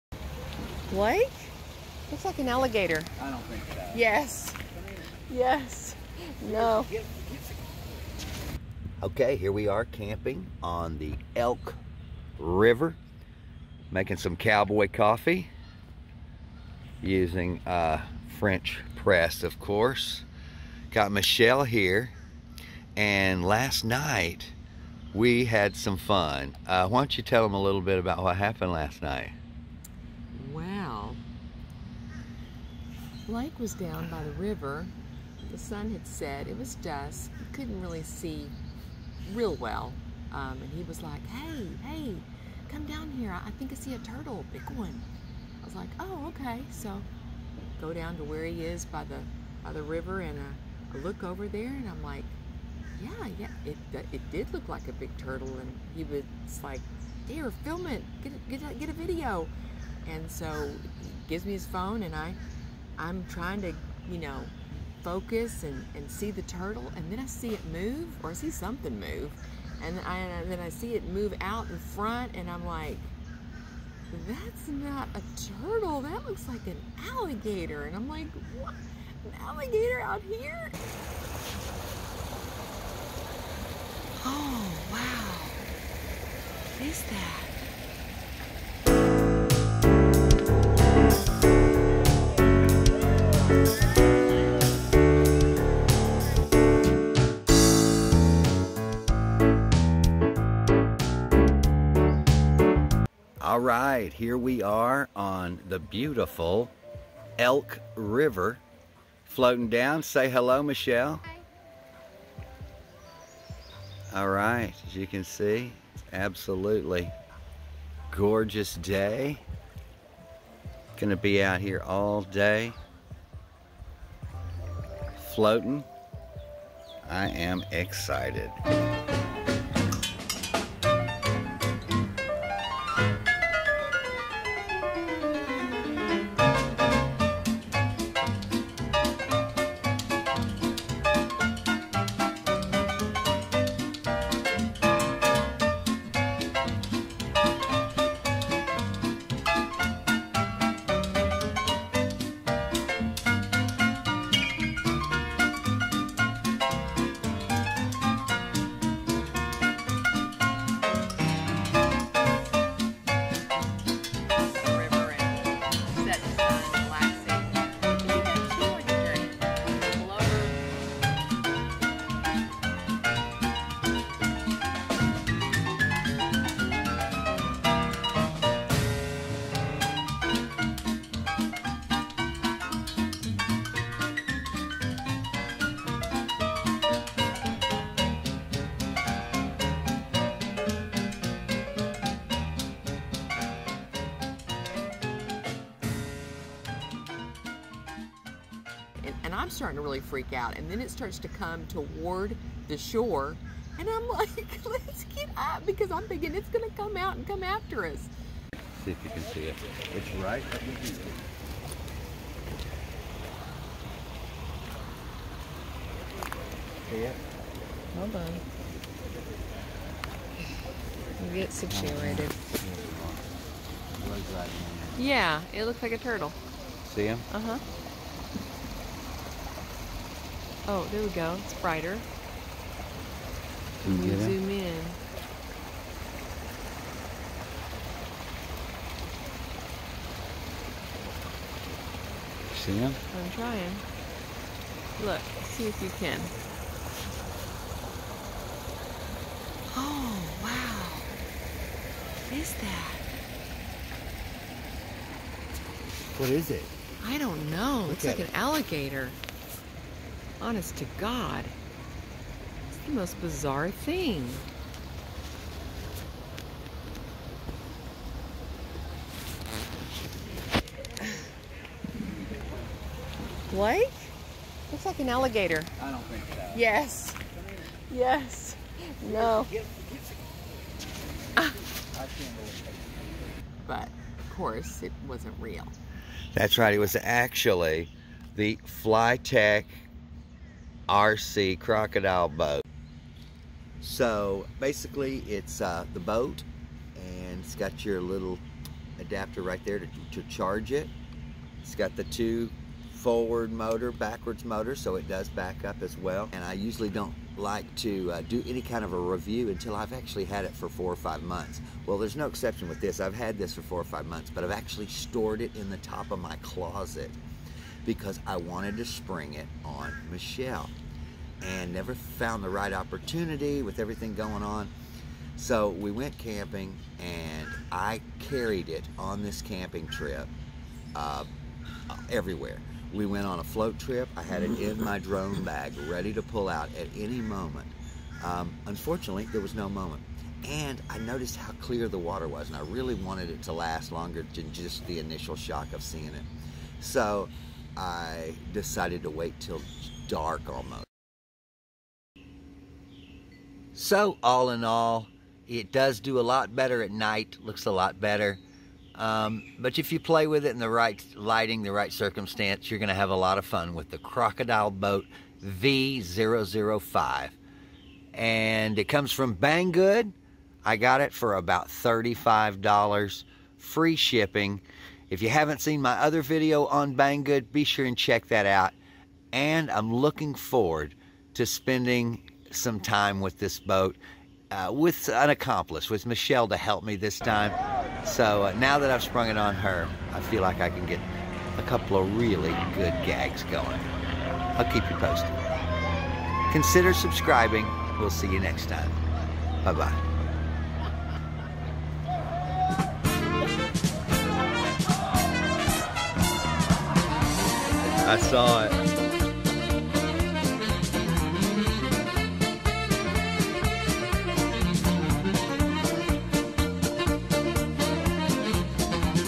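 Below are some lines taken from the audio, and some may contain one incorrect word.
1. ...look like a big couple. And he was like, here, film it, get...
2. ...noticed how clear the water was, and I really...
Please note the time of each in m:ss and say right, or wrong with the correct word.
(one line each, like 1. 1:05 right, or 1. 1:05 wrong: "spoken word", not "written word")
1. 0:54 wrong: "turtle", not "couple"
2. 5:40 right.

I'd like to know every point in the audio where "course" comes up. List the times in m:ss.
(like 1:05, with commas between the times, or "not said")
0:19, 4:44.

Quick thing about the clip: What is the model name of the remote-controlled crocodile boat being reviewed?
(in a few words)
Crocodile Boat V005.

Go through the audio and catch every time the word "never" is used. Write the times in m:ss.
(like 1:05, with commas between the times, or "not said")
5:21.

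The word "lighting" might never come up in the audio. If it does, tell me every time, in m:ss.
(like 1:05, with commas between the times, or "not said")
6:01.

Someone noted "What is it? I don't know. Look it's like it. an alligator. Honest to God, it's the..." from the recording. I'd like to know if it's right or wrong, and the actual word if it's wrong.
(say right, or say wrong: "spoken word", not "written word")
right.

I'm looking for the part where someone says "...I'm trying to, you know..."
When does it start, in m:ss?
1:02.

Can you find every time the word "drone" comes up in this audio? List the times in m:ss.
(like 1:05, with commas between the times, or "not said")
5:34.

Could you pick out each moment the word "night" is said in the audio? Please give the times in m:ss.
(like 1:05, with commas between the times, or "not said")
0:23, 0:29, 5:56.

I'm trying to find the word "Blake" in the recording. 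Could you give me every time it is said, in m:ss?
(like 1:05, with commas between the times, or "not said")
0:00, 0:33, 4:33.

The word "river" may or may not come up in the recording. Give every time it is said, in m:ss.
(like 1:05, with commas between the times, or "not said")
0:12, 0:34, 0:49, 1:47.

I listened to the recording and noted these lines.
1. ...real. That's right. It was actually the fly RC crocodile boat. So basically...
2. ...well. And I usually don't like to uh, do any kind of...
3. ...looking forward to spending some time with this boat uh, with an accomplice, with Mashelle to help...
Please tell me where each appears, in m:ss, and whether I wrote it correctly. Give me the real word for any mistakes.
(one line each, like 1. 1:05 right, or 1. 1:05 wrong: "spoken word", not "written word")
1. 4:45 right
2. 5:05 right
3. 6:19 right.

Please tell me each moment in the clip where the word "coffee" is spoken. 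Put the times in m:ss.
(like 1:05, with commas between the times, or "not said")
0:14.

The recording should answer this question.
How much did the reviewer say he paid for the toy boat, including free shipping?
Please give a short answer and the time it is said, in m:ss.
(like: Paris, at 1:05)
$35, at 6:11.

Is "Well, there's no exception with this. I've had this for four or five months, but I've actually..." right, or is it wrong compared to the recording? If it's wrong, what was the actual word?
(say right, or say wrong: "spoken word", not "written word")
right.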